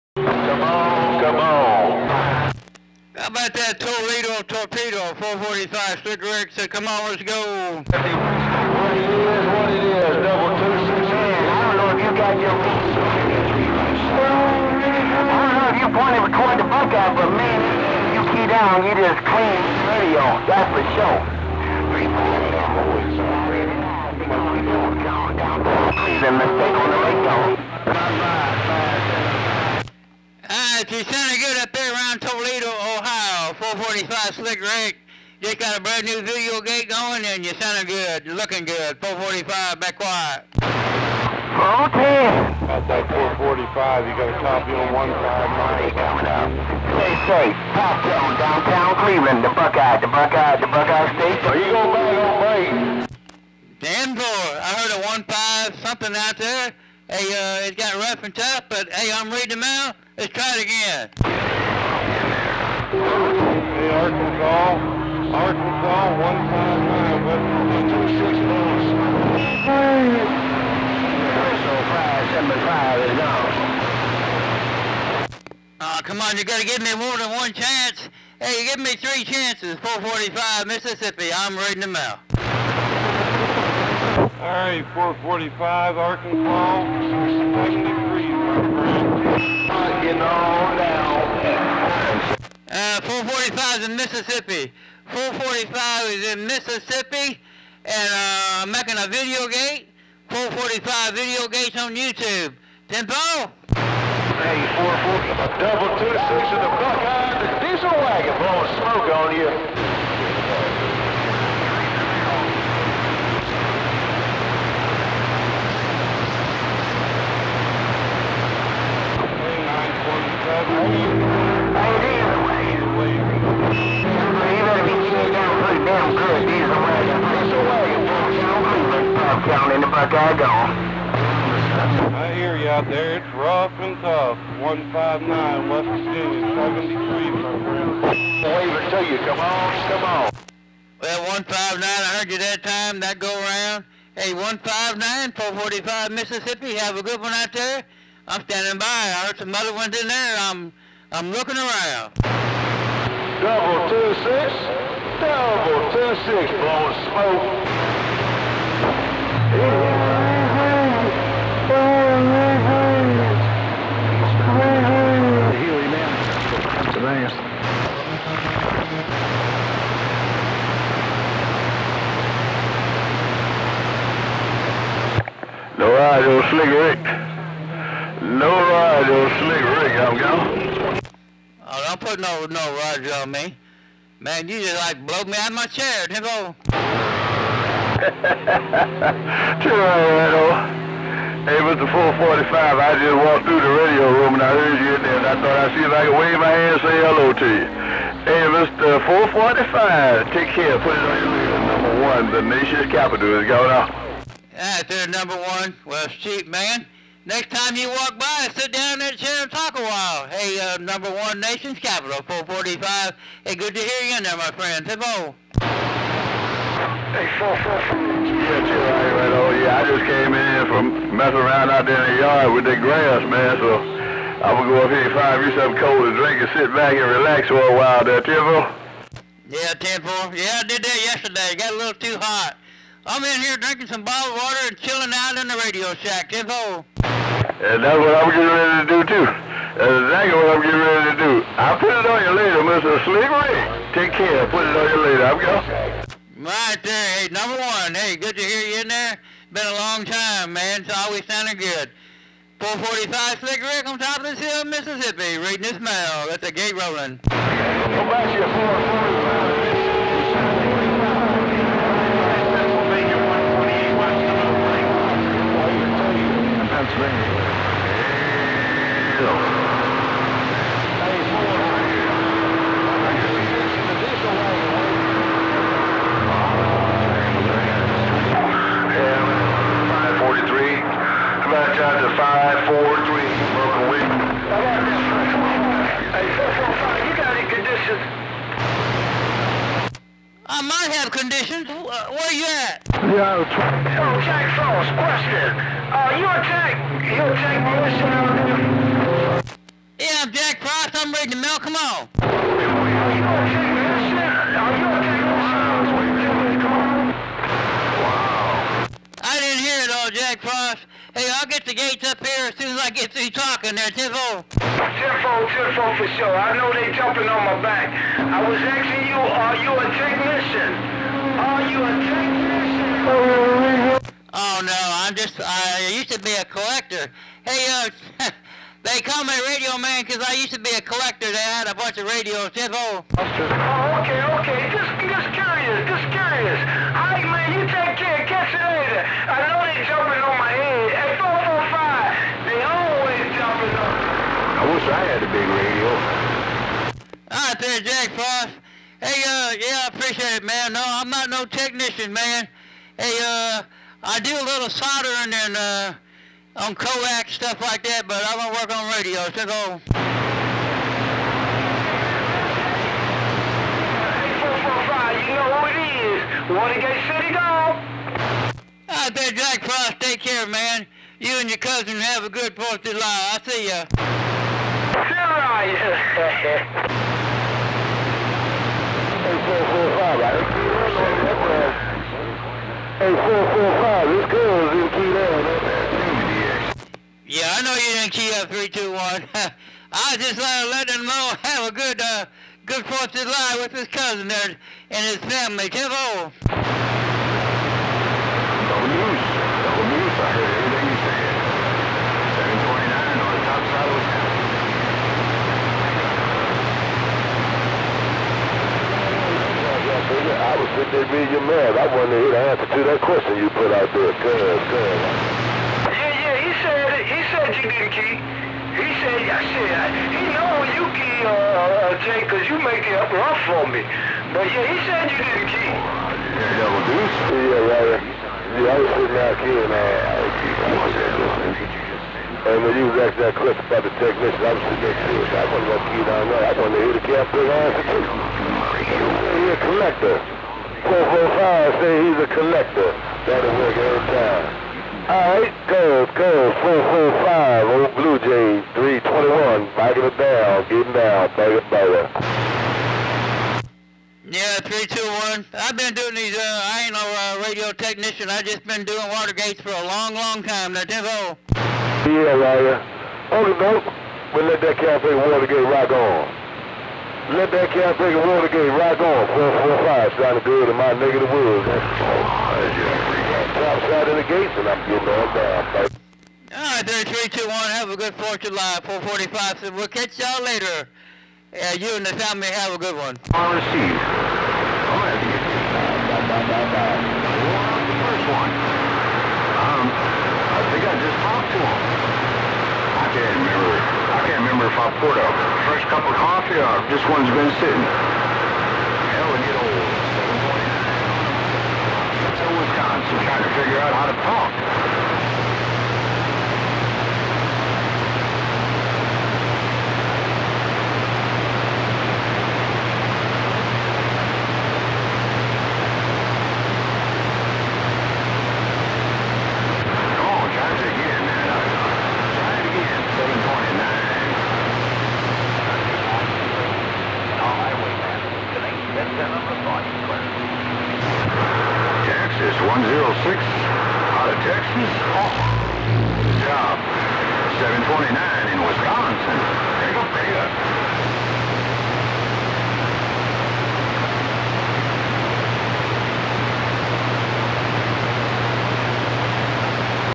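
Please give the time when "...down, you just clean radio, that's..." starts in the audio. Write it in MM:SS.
00:18.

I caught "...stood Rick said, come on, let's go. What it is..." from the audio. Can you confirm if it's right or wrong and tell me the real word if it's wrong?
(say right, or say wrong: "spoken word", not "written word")
right.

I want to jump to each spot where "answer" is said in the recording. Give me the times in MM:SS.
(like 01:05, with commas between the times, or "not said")
06:52, 07:17.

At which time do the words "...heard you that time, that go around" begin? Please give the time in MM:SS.
02:22.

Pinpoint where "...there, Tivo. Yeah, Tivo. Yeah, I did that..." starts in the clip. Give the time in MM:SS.
03:48.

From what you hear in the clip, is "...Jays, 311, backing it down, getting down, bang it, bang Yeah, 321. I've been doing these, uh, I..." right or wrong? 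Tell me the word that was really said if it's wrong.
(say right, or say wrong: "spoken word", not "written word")
wrong: "321", not "311".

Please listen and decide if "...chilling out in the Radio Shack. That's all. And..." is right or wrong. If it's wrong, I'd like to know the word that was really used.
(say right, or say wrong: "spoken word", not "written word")
right.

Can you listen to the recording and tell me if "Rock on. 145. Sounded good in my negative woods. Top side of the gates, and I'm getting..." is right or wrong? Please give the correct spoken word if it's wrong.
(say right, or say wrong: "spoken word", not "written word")
wrong: "445", not "145".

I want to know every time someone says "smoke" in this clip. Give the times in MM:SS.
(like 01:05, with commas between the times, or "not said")
01:48, 02:37.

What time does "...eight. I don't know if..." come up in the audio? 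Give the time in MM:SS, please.
00:11.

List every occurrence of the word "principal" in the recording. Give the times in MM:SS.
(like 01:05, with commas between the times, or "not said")
not said.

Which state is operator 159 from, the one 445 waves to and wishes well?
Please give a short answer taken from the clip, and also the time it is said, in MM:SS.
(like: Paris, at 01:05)
West Virginia, at 02:14.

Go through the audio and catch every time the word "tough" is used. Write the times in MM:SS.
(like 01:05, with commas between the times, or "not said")
00:58, 02:14.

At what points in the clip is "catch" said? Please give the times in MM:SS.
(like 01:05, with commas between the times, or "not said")
05:38, 07:59.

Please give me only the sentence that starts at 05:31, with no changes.
They had a bunch of radios.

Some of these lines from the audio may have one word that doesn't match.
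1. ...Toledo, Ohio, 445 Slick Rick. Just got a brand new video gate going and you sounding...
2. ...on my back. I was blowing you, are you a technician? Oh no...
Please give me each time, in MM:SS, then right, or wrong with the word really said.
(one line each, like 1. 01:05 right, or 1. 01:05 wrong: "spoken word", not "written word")
1. 00:32 right
2. 05:17 wrong: "asking", not "blowing".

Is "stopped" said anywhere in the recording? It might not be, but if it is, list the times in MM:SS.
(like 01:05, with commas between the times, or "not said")
not said.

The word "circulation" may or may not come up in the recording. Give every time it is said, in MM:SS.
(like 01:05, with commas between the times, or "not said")
not said.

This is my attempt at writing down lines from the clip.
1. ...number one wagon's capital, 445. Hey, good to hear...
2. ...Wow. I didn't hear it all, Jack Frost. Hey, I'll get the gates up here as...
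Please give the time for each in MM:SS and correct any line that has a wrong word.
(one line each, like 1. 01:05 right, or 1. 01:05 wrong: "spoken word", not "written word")
1. 03:30 wrong: "nation", not "wagon"
2. 05:08 right.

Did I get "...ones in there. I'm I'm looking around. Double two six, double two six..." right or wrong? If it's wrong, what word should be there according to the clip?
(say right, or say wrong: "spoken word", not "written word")
right.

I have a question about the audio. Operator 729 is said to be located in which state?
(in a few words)
Wisconsin.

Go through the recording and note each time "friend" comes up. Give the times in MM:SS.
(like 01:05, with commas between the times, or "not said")
02:17, 03:34.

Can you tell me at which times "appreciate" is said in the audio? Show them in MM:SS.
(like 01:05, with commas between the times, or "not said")
05:49.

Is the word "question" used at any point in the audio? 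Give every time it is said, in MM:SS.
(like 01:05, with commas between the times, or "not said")
04:54, 06:53, 07:13.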